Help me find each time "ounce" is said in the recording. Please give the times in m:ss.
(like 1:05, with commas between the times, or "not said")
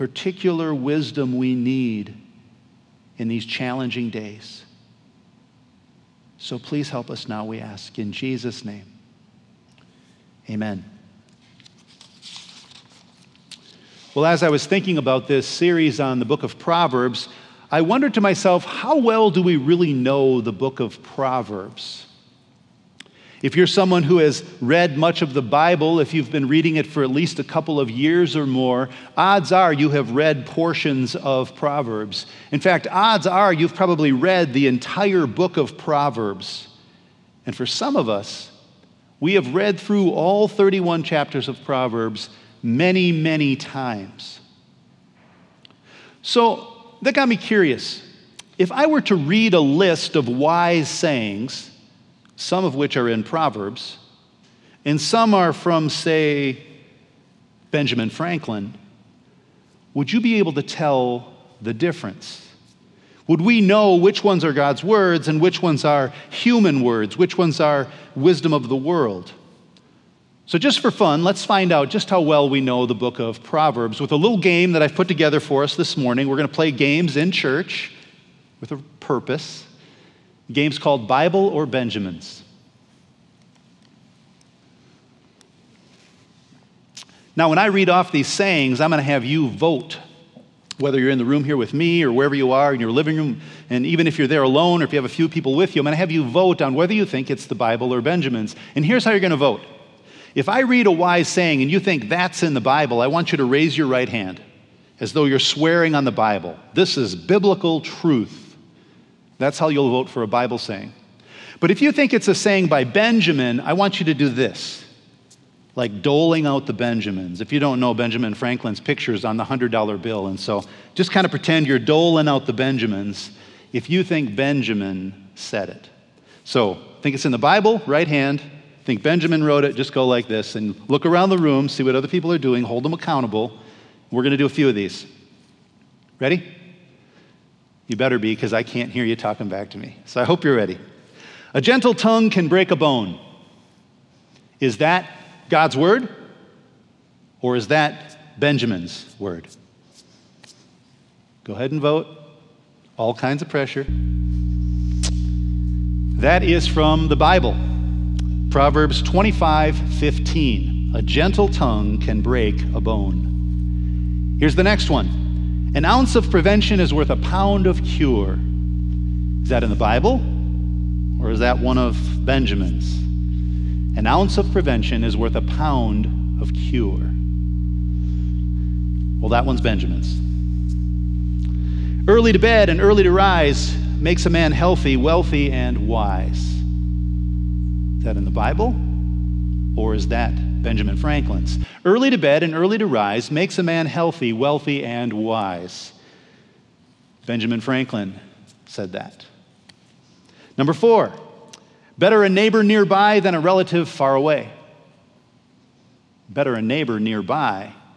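2:45, 2:54.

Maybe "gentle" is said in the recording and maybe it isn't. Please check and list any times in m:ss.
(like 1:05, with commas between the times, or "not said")
2:21, 2:41.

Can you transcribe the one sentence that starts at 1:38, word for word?
And here's how you're going to vote.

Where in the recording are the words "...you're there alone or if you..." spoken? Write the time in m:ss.
1:34.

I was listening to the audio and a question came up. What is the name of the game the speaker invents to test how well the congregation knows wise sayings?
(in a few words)
Bible or Benjamins.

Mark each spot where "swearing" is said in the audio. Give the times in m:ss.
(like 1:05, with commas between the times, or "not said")
1:45.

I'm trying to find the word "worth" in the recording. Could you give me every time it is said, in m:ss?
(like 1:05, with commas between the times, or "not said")
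2:46, 2:55.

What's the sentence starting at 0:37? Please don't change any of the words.
And for some of us, we have read through all 31 chapters of Proverbs many, many times.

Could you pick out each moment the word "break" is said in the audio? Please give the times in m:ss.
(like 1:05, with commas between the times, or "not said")
2:22, 2:42.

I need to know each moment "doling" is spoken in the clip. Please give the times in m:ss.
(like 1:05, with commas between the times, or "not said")
1:56, 2:01.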